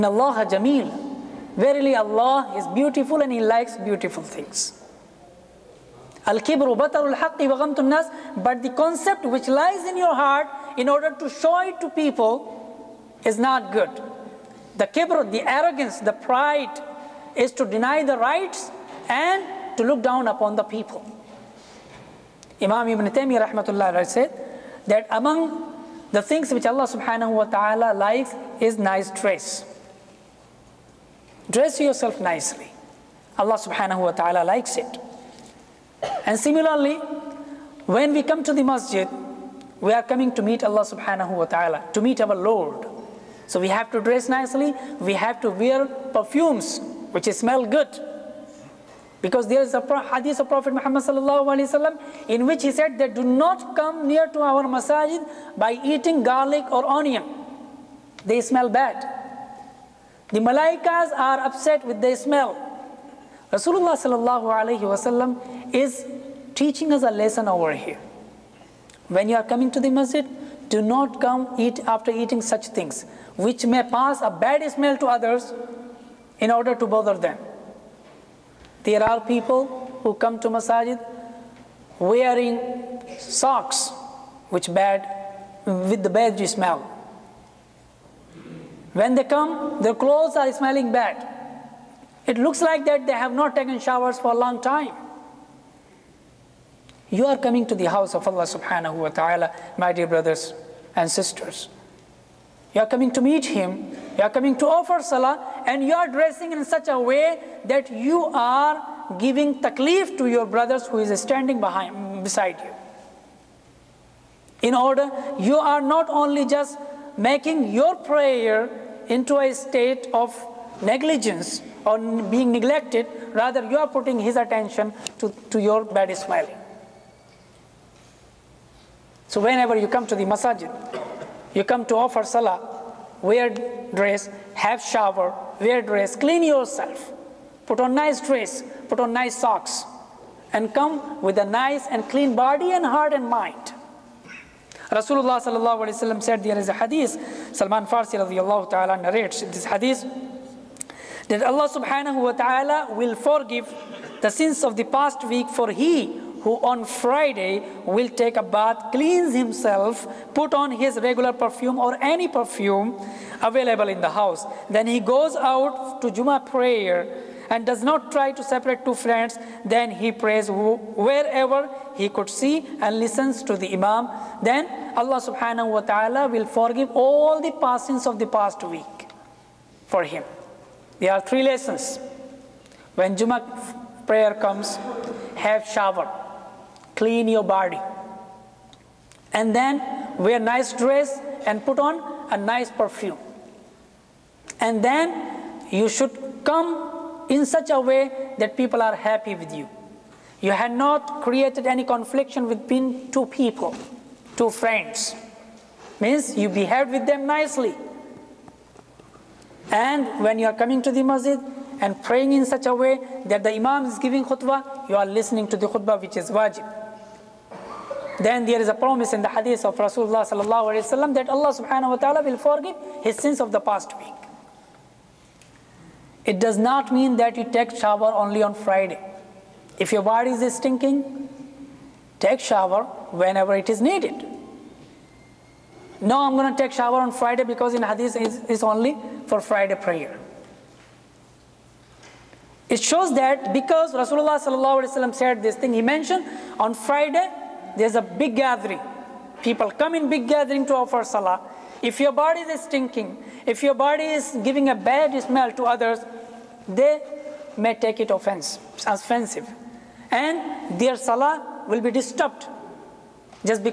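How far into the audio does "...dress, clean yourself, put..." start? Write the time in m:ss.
2:15.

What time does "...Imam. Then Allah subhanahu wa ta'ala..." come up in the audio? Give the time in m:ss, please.
2:53.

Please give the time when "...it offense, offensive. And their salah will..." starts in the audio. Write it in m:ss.
4:17.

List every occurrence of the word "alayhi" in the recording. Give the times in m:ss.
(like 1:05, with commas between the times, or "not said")
2:25.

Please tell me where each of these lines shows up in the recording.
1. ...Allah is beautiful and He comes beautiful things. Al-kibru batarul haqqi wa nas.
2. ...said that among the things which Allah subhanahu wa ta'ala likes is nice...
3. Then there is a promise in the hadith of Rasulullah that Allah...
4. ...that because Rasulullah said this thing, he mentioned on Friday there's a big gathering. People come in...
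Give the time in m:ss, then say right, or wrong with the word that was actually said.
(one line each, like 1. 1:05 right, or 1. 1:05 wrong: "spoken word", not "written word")
1. 0:01 wrong: "likes", not "comes"
2. 0:24 right
3. 3:38 right
4. 4:03 right.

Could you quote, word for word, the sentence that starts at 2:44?
Then he goes out to Juma prayer and does not try to separate two friends.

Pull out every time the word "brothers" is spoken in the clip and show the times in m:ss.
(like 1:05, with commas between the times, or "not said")
1:40, 1:50.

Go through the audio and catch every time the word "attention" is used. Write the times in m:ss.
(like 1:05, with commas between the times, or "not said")
2:04.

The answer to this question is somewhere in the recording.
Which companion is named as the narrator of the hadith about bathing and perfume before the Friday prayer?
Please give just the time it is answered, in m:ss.
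2:27.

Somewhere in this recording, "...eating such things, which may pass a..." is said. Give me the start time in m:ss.
1:12.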